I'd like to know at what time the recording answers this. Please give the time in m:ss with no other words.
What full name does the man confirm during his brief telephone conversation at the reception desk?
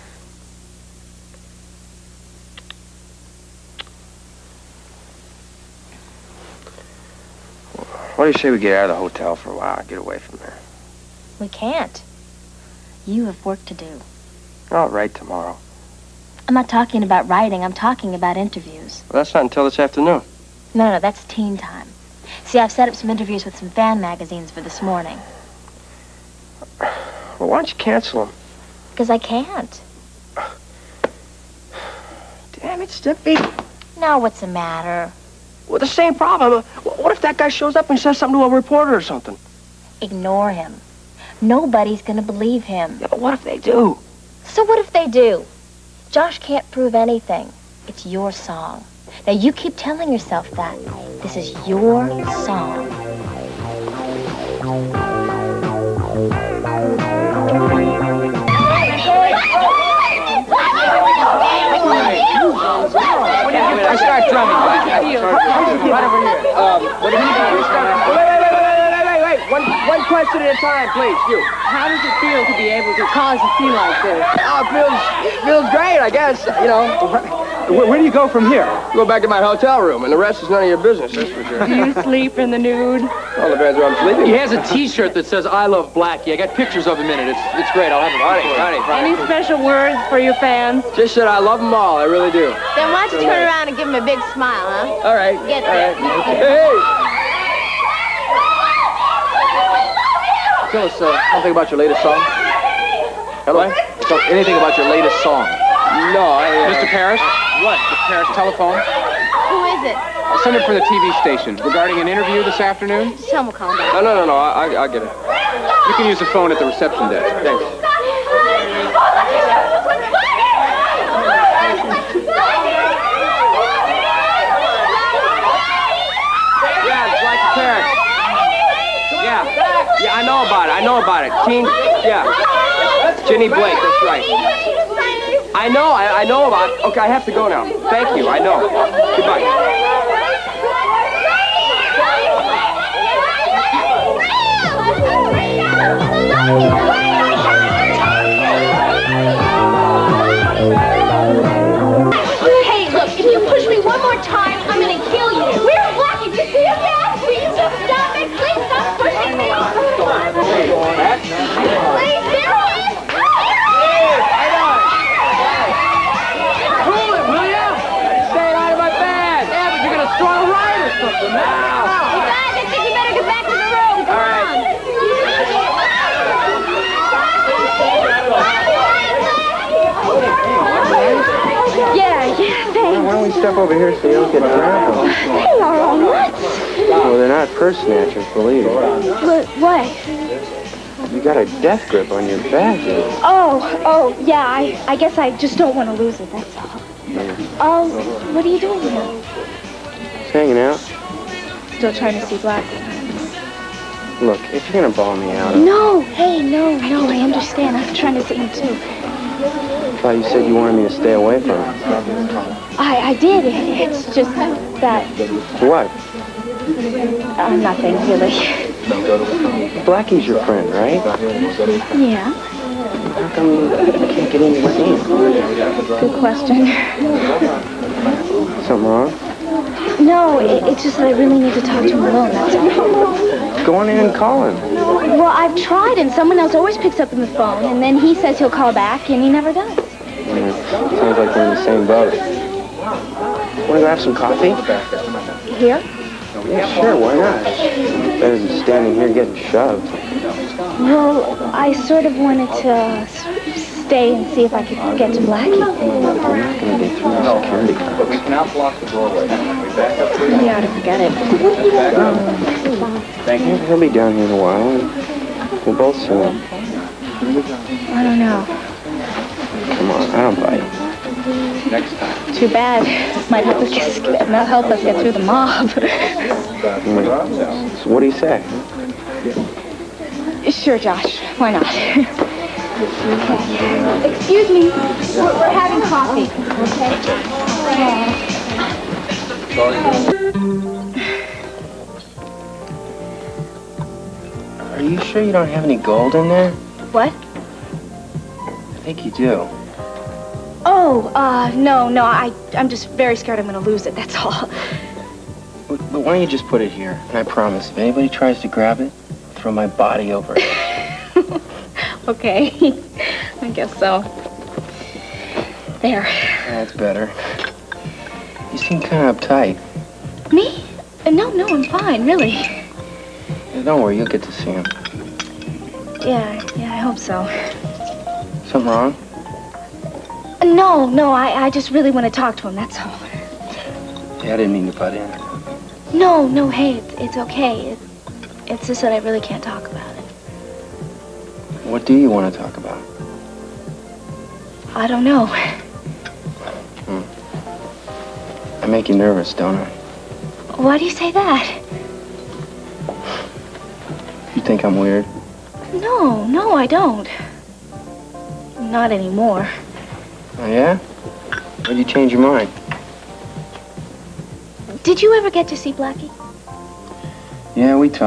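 2:13.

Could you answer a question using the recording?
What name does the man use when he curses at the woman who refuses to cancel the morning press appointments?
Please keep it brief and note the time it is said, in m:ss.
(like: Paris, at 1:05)
Steffi, at 0:32.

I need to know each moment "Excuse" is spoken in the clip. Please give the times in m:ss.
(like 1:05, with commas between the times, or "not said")
4:42.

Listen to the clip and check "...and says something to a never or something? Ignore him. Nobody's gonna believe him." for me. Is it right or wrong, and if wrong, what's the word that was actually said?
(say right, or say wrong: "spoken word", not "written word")
wrong: "reporter", not "never".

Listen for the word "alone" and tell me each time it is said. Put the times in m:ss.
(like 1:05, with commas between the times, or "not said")
3:52.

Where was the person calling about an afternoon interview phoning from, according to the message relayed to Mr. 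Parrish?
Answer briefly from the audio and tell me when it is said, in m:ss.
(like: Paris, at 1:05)
the TV station, at 1:50.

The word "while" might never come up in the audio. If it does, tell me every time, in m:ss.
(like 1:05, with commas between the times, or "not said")
0:09, 4:24.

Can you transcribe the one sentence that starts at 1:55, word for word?
You can use the phone at the reception desk.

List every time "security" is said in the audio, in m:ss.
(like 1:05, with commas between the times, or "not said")
4:17.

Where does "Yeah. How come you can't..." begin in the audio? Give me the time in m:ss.
3:41.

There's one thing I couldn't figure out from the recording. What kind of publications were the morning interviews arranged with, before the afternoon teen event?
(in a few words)
fan magazines.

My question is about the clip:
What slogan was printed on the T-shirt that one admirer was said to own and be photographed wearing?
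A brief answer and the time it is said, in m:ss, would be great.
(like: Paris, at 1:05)
I love Blackie, at 1:25.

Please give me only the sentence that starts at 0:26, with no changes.
Well, why don't you cancel them?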